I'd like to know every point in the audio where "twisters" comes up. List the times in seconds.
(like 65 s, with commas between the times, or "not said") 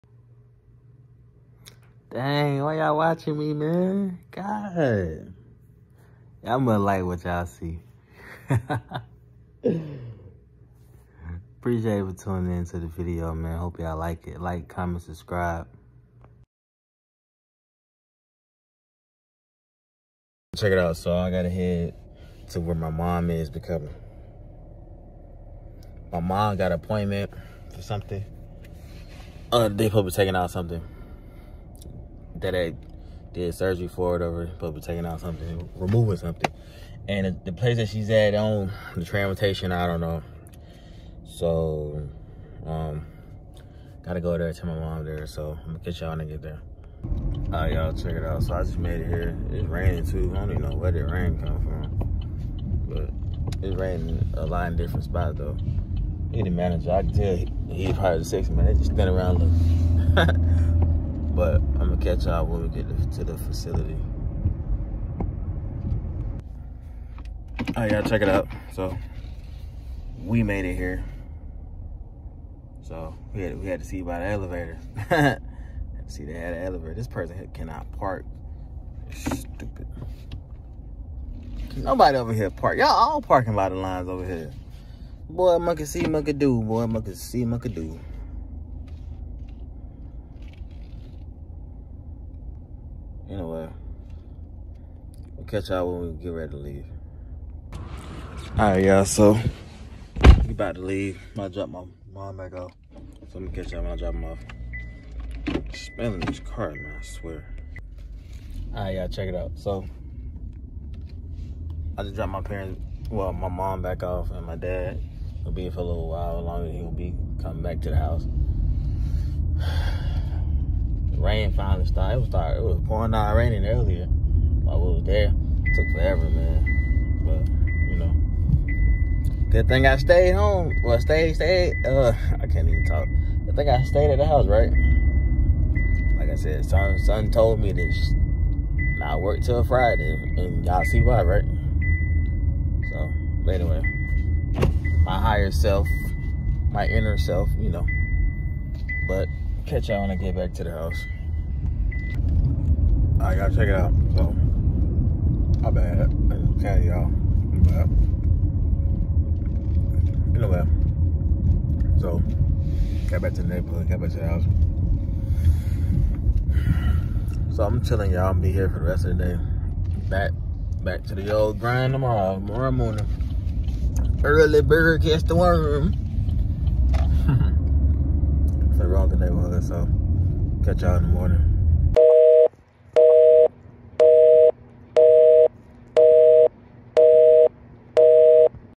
not said.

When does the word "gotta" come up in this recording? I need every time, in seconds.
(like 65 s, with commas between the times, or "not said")
21 s, 44 s, 153 s.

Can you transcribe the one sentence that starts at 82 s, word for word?
Y'all all parking by the lines over here.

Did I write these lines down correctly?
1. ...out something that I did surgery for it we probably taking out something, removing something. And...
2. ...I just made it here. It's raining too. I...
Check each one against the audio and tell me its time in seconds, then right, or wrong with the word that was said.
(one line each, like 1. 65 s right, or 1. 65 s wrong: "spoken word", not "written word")
1. 30 s right
2. 48 s right.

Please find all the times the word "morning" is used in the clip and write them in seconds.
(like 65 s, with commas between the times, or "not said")
172 s, 181 s.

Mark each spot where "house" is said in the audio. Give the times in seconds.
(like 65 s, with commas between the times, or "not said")
117 s, 134 s, 150 s, 164 s.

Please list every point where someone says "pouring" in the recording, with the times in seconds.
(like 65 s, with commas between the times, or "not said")
122 s.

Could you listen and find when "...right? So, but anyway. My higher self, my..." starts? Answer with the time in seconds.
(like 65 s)
141 s.